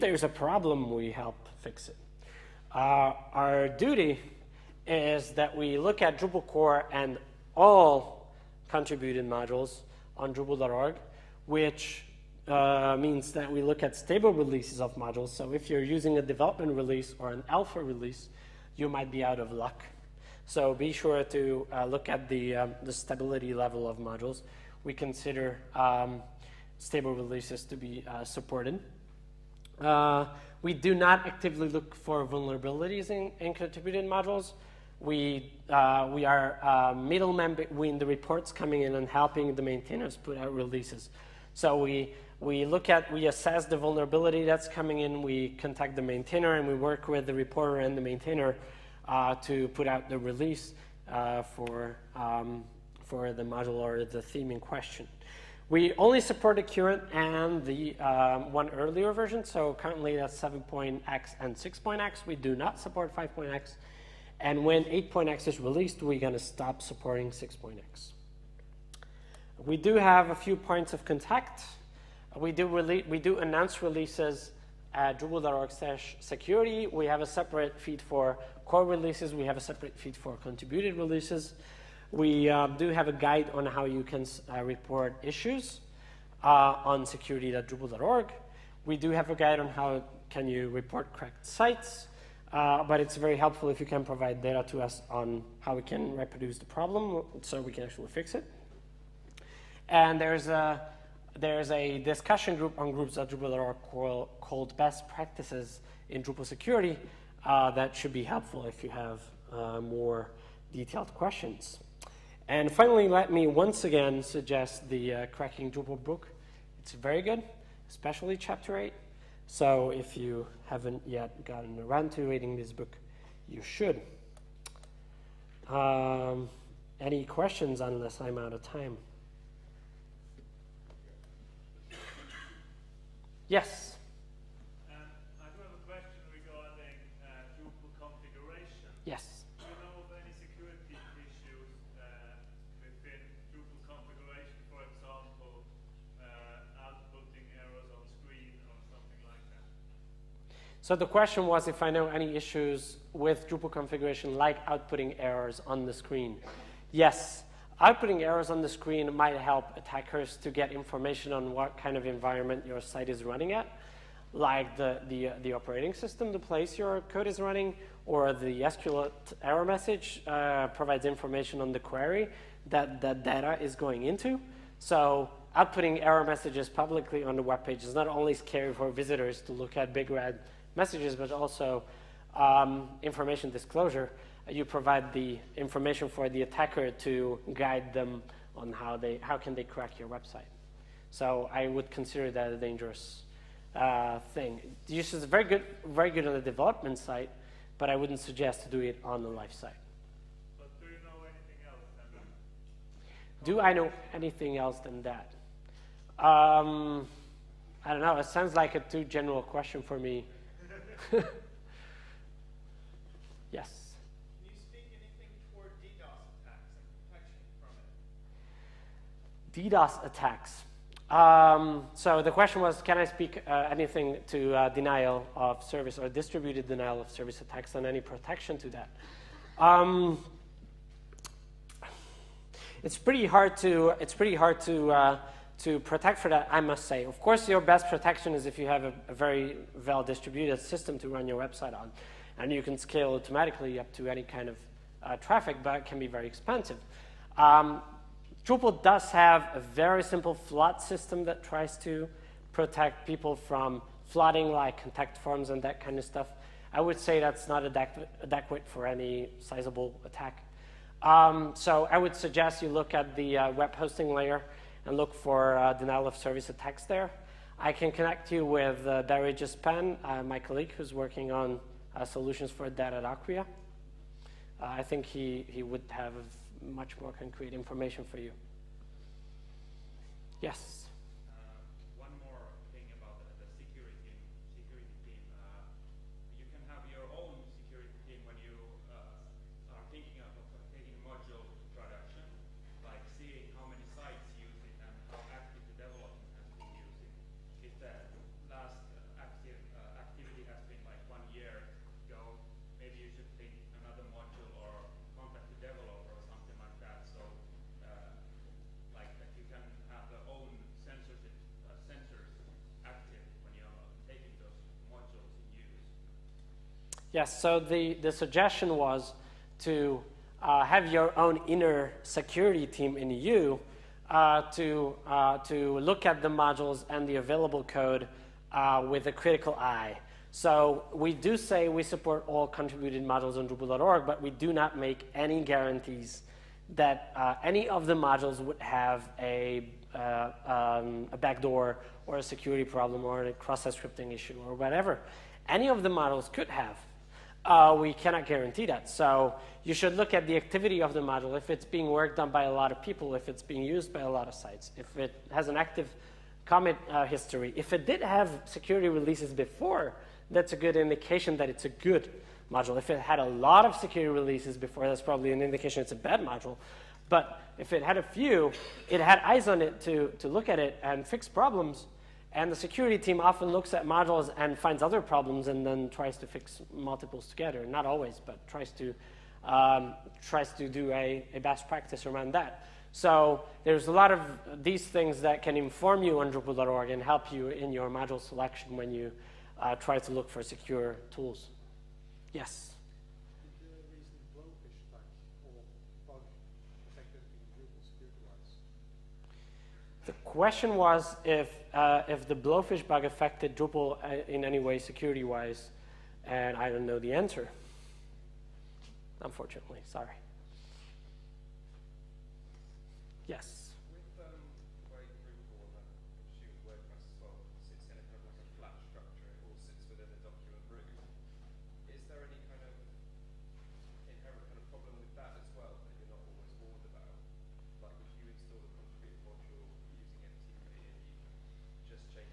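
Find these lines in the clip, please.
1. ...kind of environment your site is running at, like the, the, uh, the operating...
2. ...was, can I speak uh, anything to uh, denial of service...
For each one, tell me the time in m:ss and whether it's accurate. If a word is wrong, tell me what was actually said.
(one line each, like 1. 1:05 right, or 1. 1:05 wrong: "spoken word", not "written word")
1. 2:41 right
2. 3:42 right.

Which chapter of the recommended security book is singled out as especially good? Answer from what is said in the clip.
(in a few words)
Chapter 8.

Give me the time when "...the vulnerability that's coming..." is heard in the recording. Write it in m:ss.
0:43.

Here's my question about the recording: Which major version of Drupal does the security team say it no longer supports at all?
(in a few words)
5.x.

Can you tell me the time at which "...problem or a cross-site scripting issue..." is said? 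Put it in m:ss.
5:42.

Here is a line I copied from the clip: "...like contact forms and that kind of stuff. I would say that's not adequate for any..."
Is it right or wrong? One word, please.
right.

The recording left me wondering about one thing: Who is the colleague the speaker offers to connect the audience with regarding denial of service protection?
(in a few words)
Barry Jaspan.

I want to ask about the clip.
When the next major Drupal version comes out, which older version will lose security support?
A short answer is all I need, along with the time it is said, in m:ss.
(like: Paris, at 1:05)
6.x, at 1:06.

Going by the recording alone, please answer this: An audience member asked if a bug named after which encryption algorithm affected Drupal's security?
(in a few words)
Blowfish.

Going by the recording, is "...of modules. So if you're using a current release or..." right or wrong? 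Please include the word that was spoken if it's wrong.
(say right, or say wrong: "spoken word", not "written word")
wrong: "development", not "current".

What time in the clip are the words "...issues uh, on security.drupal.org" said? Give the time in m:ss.
1:25.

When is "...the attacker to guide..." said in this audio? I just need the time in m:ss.
3:06.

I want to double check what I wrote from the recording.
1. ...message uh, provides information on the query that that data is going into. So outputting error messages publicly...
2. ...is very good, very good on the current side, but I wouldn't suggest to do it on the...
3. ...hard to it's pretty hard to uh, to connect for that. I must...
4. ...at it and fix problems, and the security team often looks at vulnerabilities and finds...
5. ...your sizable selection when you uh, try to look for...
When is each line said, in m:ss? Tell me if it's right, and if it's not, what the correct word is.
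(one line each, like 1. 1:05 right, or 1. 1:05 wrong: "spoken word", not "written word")
1. 2:49 right
2. 3:15 wrong: "development", not "current"
3. 3:53 wrong: "protect", not "connect"
4. 6:10 wrong: "modules", not "vulnerabilities"
5. 6:27 wrong: "module", not "sizable".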